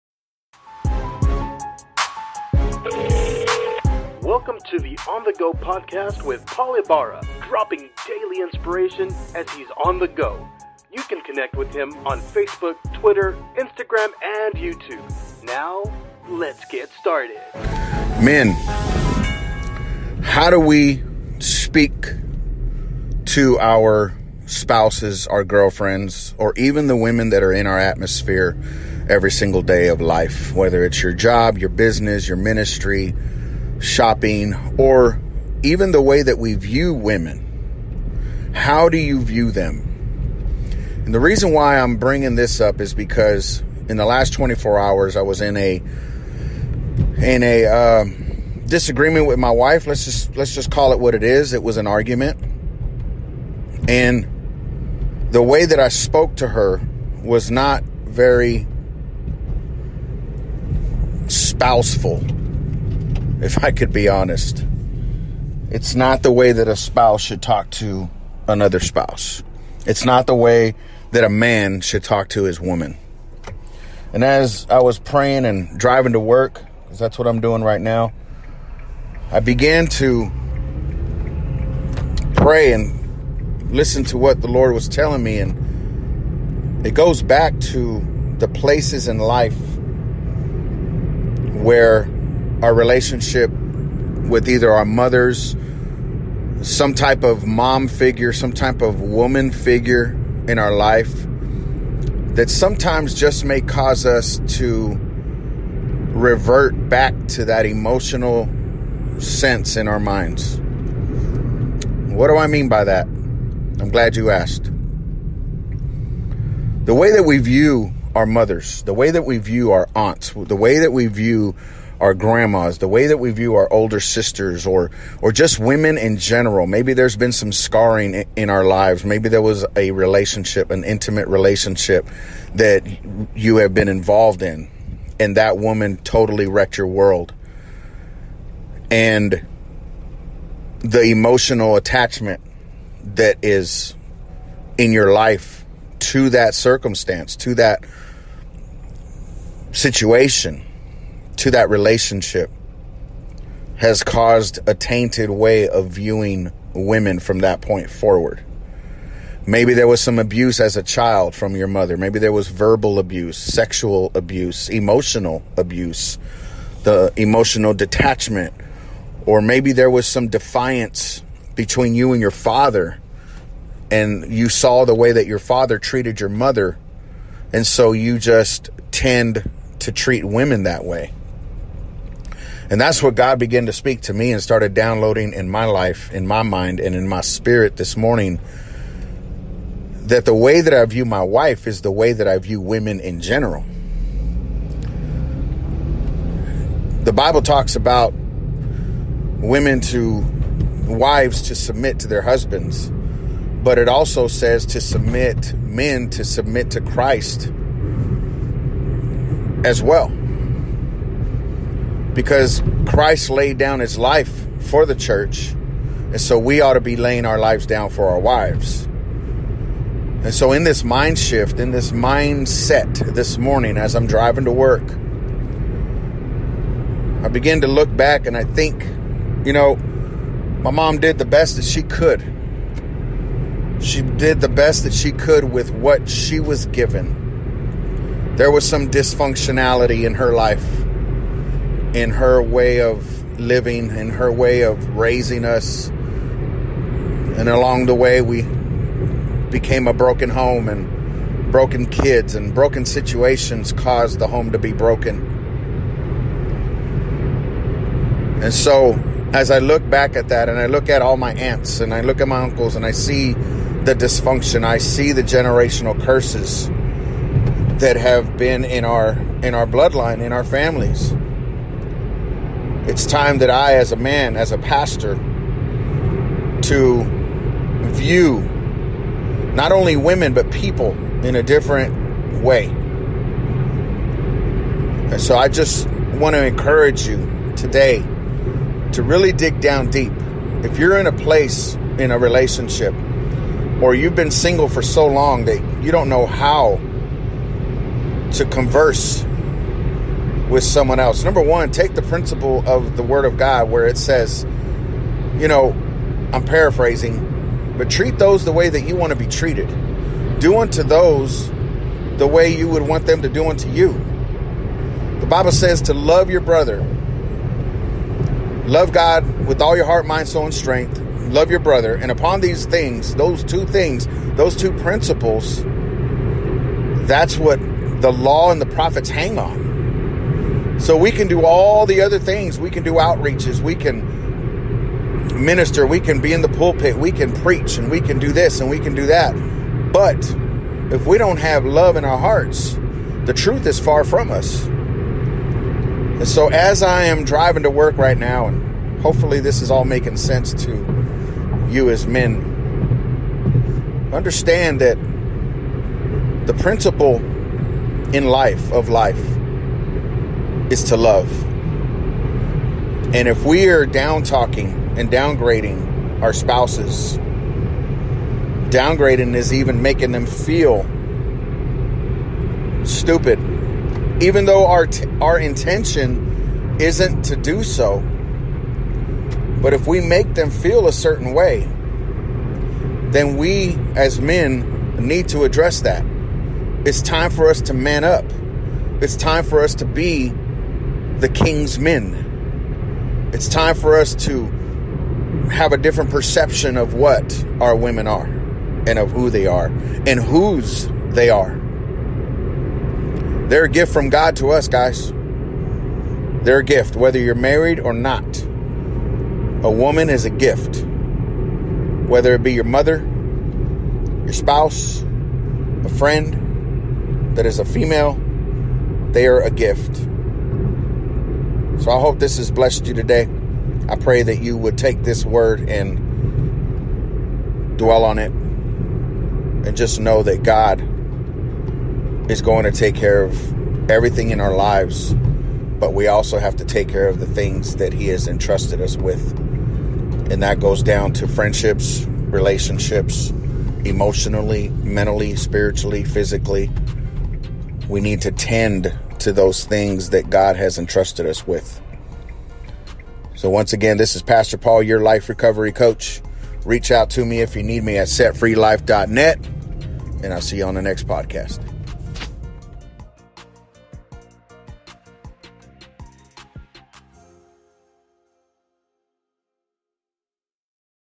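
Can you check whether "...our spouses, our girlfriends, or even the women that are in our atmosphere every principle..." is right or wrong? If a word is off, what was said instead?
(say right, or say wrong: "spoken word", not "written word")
wrong: "single", not "principle".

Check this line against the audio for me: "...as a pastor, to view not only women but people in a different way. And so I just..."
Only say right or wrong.
right.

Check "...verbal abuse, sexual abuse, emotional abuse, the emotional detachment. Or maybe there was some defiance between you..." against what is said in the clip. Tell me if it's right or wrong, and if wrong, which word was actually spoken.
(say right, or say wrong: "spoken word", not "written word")
right.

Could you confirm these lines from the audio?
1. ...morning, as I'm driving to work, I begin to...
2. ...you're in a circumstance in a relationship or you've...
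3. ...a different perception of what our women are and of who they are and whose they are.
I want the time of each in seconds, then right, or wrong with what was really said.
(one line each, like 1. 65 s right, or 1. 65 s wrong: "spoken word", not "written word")
1. 223 s right
2. 290 s wrong: "place", not "circumstance"
3. 395 s right.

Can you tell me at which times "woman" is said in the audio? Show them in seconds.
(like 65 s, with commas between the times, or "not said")
72 s, 99 s, 135 s, 409 s.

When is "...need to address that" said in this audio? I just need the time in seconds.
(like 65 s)
385 s.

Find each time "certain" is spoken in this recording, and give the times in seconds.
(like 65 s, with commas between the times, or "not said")
380 s.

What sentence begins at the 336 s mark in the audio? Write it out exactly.
We can preach and we can do this and we can do that.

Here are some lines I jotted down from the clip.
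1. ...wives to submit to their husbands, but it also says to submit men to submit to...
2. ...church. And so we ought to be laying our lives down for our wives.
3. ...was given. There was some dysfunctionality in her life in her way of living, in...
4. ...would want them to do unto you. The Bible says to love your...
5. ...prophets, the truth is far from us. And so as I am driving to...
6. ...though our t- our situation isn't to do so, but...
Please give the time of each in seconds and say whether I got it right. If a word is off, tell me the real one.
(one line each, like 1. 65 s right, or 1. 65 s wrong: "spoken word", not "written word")
1. 200 s right
2. 214 s right
3. 236 s right
4. 312 s right
5. 342 s wrong: "hearts", not "prophets"
6. 374 s wrong: "intention", not "situation".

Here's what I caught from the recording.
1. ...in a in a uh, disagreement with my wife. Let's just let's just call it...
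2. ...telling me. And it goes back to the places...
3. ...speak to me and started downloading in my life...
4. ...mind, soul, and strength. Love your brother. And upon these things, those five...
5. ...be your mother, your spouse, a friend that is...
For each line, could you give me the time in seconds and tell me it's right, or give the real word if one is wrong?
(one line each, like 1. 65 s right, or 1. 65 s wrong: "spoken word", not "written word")
1. 45 s right
2. 84 s right
3. 183 s right
4. 320 s wrong: "two", not "five"
5. 412 s right.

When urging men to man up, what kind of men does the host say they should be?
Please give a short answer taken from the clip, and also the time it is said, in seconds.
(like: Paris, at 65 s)
The king's men, at 391 s.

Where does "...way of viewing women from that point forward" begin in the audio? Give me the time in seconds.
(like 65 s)
155 s.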